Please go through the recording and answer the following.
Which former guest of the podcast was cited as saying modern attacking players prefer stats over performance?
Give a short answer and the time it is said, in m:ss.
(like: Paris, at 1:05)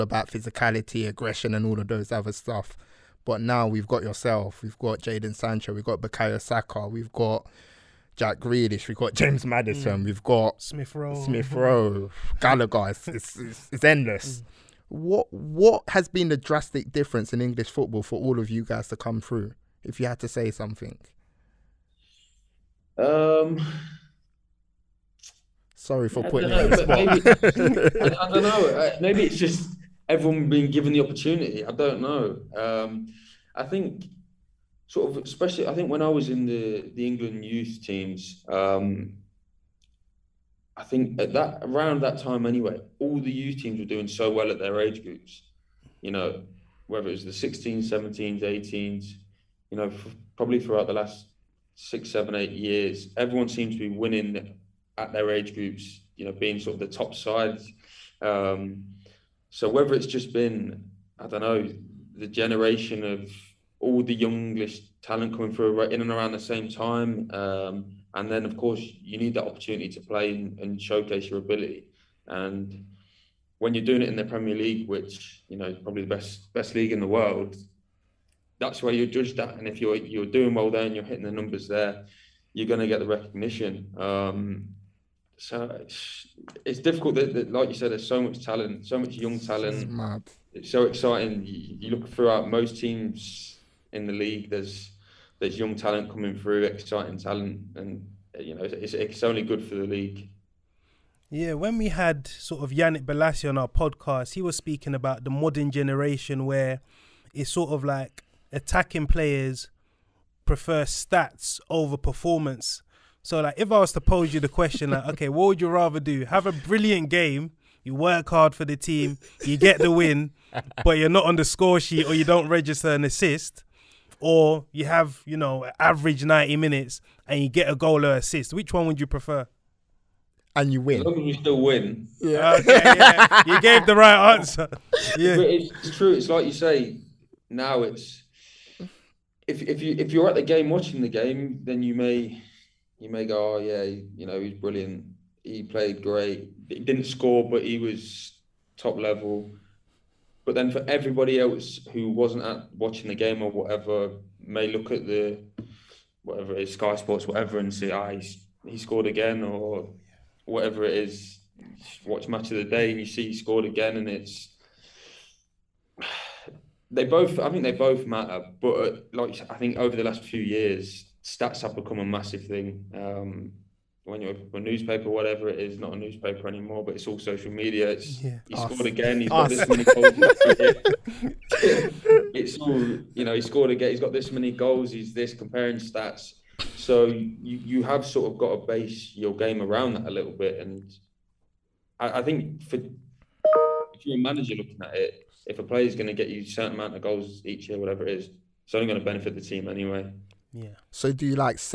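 Yannick Bolasie, at 1:42.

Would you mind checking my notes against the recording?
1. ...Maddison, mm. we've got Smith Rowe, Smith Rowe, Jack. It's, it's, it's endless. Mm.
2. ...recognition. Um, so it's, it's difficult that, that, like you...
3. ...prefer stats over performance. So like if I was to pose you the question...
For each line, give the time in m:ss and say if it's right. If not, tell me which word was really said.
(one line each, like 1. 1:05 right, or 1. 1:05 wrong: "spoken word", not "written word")
1. 0:09 wrong: "Gallagher", not "Jack"
2. 1:23 right
3. 1:50 right.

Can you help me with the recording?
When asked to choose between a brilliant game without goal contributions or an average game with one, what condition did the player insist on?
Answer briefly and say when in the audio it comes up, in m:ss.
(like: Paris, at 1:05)
As long as we still win, at 2:11.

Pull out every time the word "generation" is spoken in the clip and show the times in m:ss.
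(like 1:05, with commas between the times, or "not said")
1:02, 1:45.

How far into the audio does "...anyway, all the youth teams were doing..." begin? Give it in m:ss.
0:42.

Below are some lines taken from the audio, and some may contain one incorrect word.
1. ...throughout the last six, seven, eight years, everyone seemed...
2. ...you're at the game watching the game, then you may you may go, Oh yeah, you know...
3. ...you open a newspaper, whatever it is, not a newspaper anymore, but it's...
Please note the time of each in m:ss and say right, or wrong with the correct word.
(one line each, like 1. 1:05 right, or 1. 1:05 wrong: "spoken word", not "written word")
1. 0:50 right
2. 2:20 right
3. 2:54 right.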